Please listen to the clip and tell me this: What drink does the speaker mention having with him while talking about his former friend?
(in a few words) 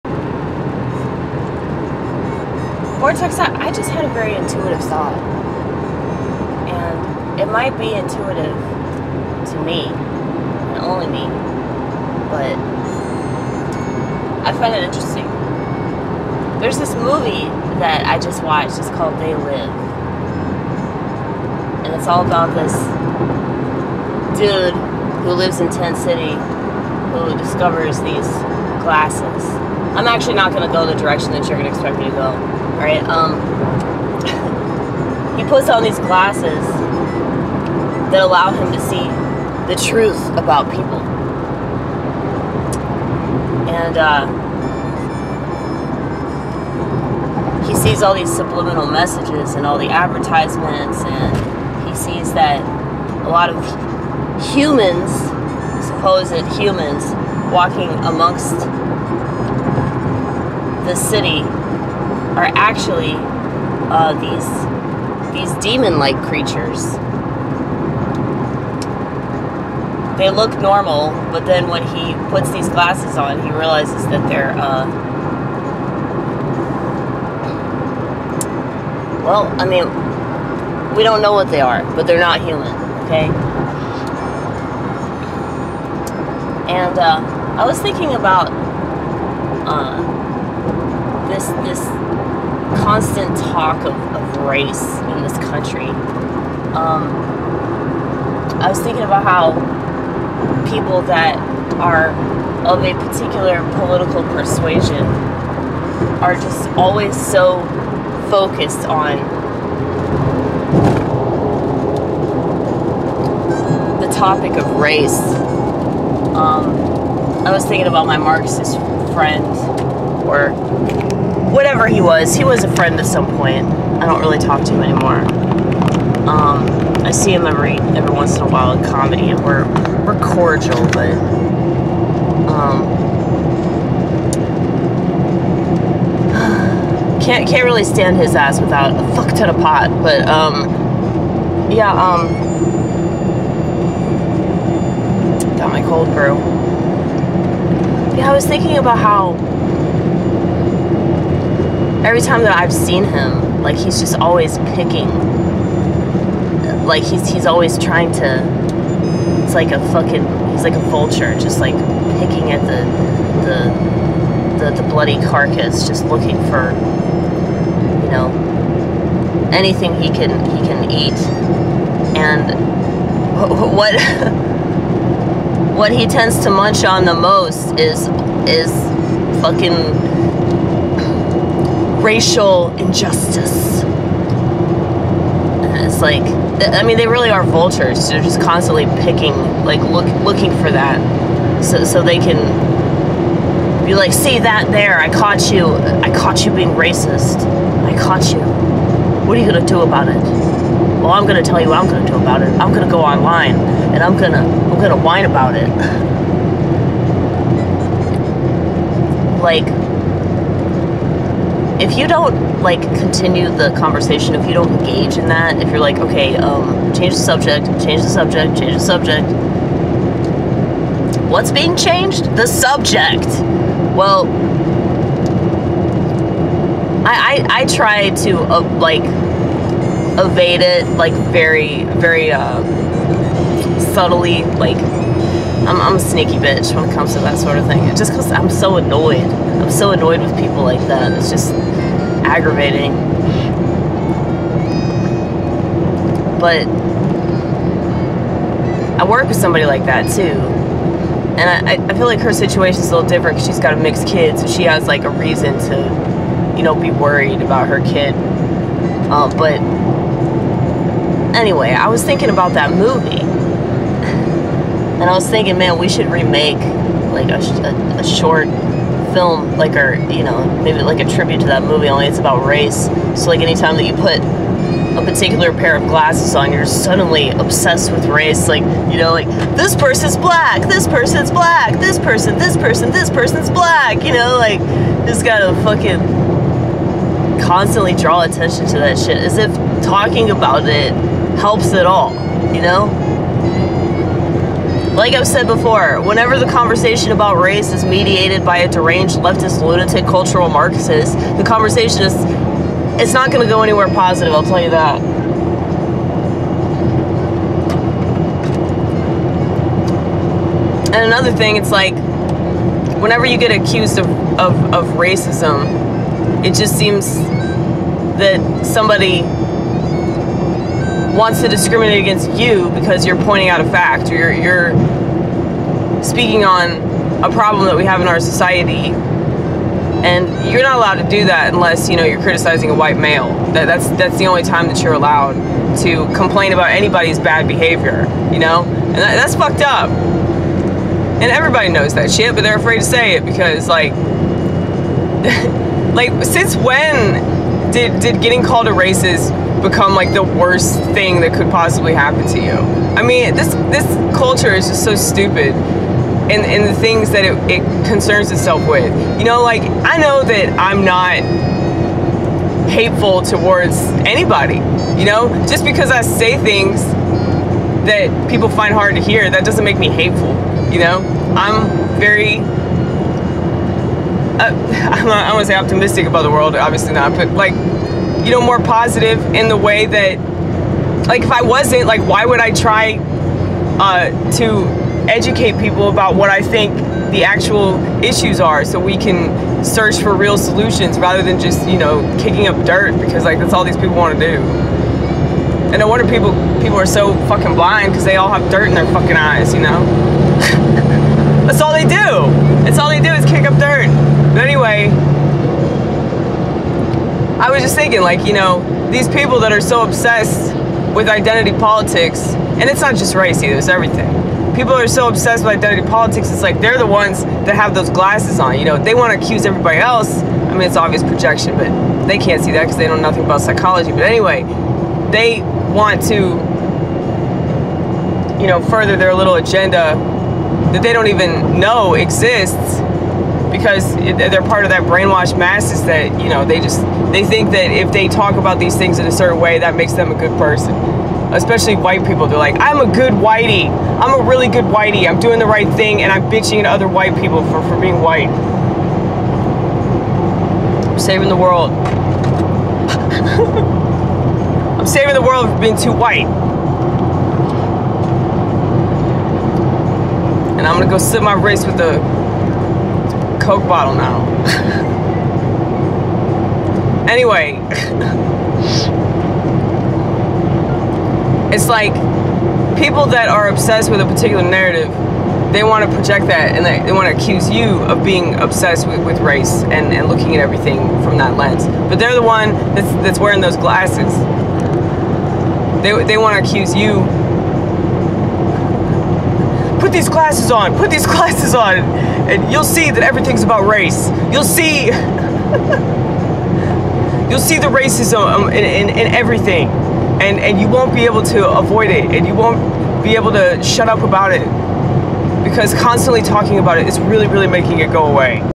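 Cold brew.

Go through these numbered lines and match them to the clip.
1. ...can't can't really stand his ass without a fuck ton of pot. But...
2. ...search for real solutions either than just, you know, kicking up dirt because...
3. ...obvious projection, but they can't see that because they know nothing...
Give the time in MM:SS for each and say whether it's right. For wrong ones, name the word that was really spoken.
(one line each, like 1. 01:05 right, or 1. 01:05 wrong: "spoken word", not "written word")
1. 02:17 right
2. 06:29 wrong: "rather", not "either"
3. 07:00 right.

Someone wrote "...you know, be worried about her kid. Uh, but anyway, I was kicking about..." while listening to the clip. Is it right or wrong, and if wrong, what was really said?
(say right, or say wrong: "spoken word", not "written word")
wrong: "thinking", not "kicking".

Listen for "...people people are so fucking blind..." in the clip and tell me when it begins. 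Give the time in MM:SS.
06:36.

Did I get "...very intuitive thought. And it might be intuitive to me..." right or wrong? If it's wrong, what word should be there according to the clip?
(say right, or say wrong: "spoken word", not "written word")
right.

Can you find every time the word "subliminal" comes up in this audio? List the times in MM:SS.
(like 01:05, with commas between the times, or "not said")
00:48.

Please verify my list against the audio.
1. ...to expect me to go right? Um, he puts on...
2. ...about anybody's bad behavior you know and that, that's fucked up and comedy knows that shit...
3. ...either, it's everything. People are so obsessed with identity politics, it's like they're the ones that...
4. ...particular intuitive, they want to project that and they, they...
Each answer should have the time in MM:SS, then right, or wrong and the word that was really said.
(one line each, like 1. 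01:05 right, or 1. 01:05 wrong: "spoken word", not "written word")
1. 00:31 right
2. 05:36 wrong: "everybody", not "comedy"
3. 06:53 right
4. 07:54 wrong: "narrative", not "intuitive".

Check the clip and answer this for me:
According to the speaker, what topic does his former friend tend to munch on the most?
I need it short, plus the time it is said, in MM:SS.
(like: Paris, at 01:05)
Racial injustice, at 03:02.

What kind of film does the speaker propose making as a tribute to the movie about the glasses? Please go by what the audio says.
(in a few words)
A short film.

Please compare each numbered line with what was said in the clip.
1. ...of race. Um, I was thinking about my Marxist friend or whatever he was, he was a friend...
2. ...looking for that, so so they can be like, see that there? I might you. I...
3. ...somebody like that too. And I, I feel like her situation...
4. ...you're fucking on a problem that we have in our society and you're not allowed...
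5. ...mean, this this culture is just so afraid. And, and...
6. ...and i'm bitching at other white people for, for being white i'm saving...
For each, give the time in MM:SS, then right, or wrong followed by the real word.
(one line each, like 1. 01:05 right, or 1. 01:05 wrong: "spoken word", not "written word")
1. 01:54 right
2. 03:10 wrong: "caught", not "might"
3. 04:09 right
4. 05:24 wrong: "speaking", not "fucking"
5. 05:53 wrong: "stupid", not "afraid"
6. 07:26 right.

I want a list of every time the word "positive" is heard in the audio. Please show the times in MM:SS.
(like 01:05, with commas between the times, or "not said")
05:03, 06:18.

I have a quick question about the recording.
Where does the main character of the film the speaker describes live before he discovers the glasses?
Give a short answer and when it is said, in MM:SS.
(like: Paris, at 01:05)
Tent City, at 00:25.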